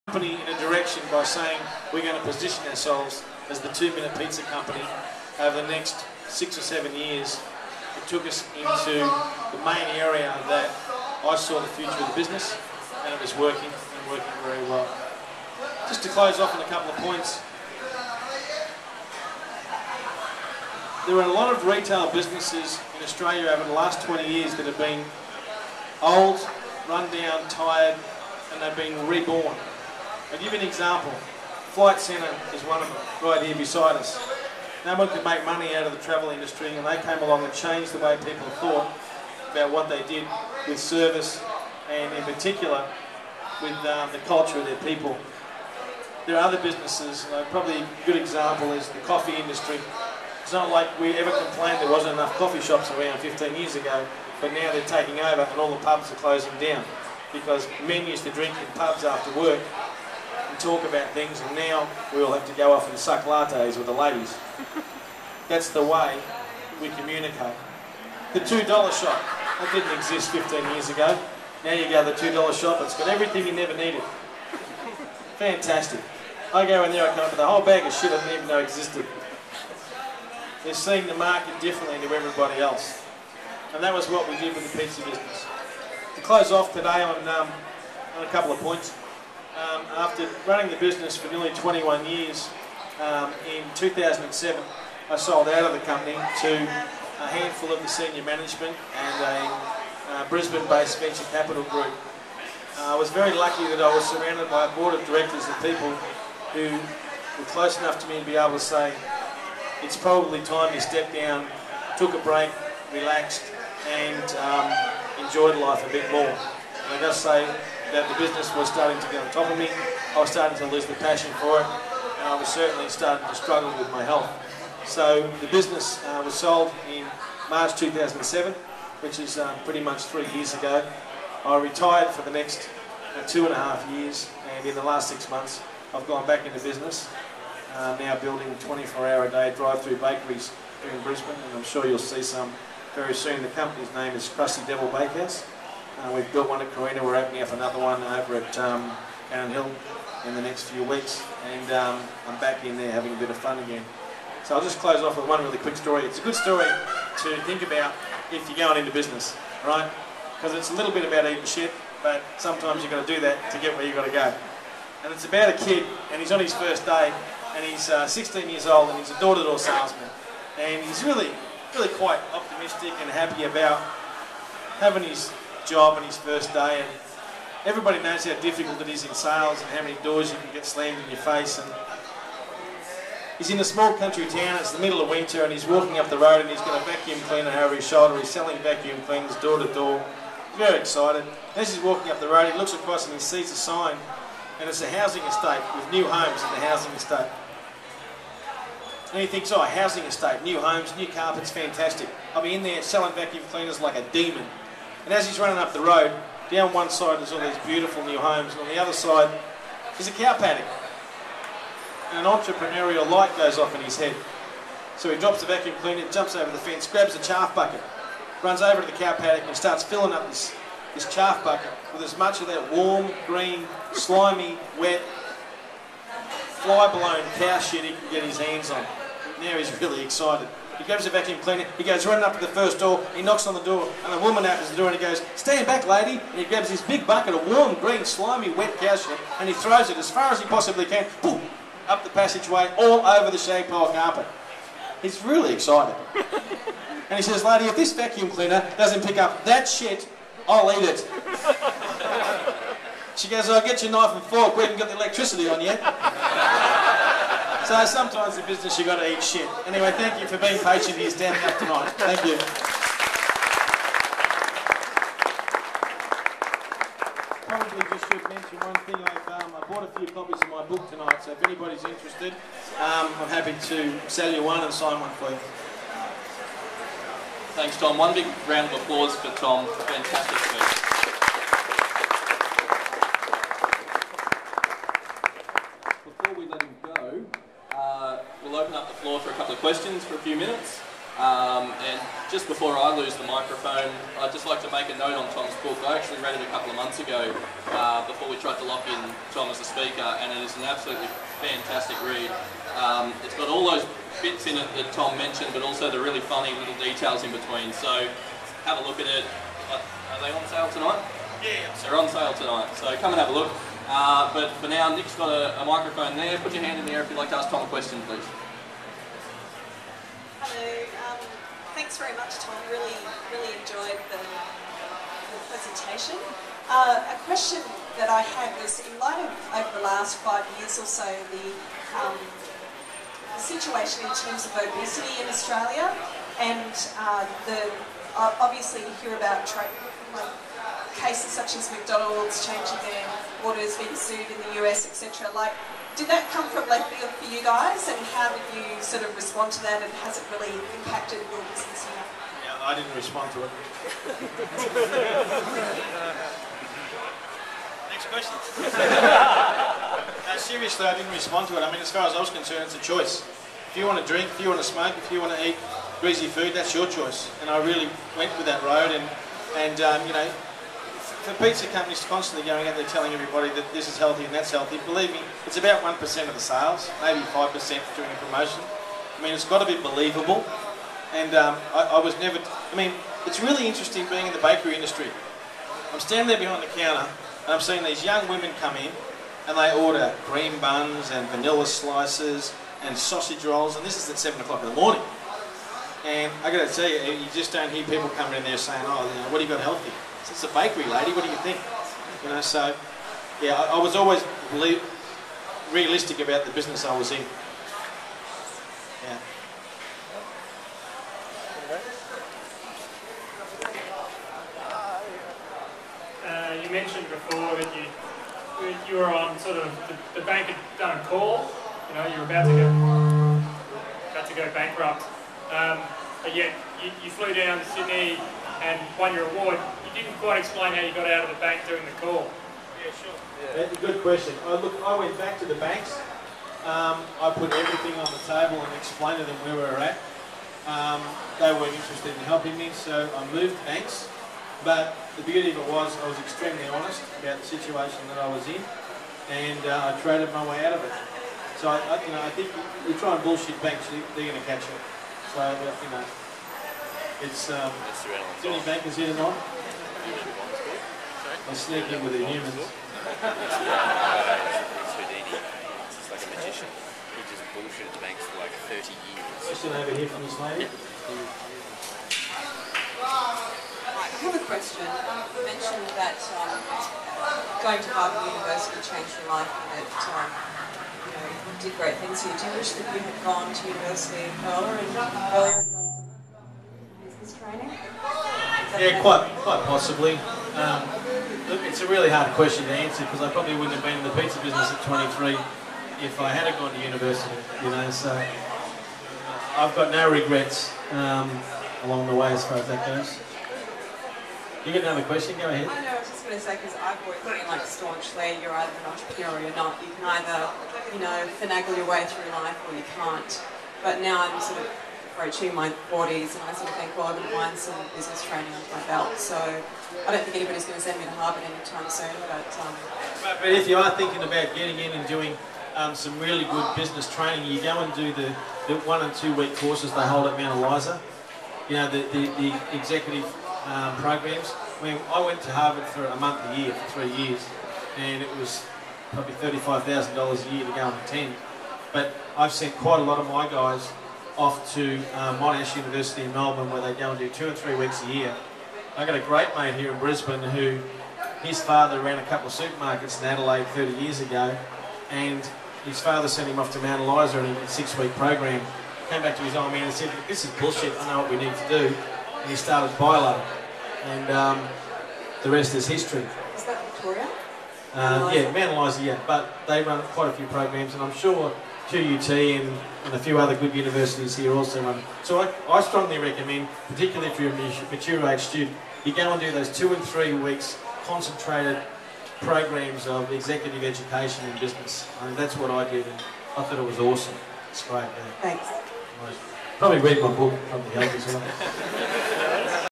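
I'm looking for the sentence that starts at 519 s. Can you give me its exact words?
So I don't think anybody's going to send me to Harvard anytime soon.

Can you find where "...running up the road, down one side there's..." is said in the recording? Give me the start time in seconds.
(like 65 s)
205 s.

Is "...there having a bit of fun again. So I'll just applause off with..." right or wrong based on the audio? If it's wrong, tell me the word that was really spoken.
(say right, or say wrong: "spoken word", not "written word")
wrong: "close", not "applause".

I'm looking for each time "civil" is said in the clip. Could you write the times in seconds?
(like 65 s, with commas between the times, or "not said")
not said.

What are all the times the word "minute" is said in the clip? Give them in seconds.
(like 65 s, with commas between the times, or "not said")
3 s, 290 s.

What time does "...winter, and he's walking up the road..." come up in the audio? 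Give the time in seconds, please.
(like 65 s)
185 s.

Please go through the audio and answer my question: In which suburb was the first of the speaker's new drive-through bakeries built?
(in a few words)
Carina.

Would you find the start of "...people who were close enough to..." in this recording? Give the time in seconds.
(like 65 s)
105 s.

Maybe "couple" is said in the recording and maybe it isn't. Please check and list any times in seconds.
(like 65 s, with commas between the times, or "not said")
16 s, 88 s, 296 s, 552 s.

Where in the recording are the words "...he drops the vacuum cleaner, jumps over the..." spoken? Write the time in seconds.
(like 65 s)
215 s.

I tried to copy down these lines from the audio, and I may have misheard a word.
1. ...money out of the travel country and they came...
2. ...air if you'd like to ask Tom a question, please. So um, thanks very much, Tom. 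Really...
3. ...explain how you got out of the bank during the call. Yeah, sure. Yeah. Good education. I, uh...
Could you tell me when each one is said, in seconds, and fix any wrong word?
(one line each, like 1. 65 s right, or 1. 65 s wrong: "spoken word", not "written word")
1. 35 s wrong: "industry", not "country"
2. 316 s right
3. 430 s wrong: "question", not "education".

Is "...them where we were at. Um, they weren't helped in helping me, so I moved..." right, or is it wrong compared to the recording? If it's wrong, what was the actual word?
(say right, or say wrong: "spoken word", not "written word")
wrong: "interested", not "helped".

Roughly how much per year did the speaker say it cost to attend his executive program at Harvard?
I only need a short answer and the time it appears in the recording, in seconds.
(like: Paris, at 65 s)
$35,000, at 539 s.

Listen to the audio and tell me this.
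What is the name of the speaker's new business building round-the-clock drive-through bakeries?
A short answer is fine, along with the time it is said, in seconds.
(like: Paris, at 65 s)
Crusty Devil Bakehouse, at 144 s.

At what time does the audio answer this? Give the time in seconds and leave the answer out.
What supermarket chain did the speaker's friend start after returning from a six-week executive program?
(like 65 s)
562 s.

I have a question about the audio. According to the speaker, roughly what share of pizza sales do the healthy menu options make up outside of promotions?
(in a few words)
1%.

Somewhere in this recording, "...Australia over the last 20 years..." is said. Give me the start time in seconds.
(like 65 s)
23 s.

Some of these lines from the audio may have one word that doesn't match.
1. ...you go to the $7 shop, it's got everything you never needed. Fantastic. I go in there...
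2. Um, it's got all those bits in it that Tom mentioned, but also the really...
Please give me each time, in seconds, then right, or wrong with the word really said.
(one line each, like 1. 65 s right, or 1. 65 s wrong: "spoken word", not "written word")
1. 71 s wrong: "2", not "7"
2. 302 s right.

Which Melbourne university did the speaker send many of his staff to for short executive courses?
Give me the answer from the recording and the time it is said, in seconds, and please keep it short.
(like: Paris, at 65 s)
Monash University, at 545 s.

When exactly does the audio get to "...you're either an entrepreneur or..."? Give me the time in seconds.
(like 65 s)
508 s.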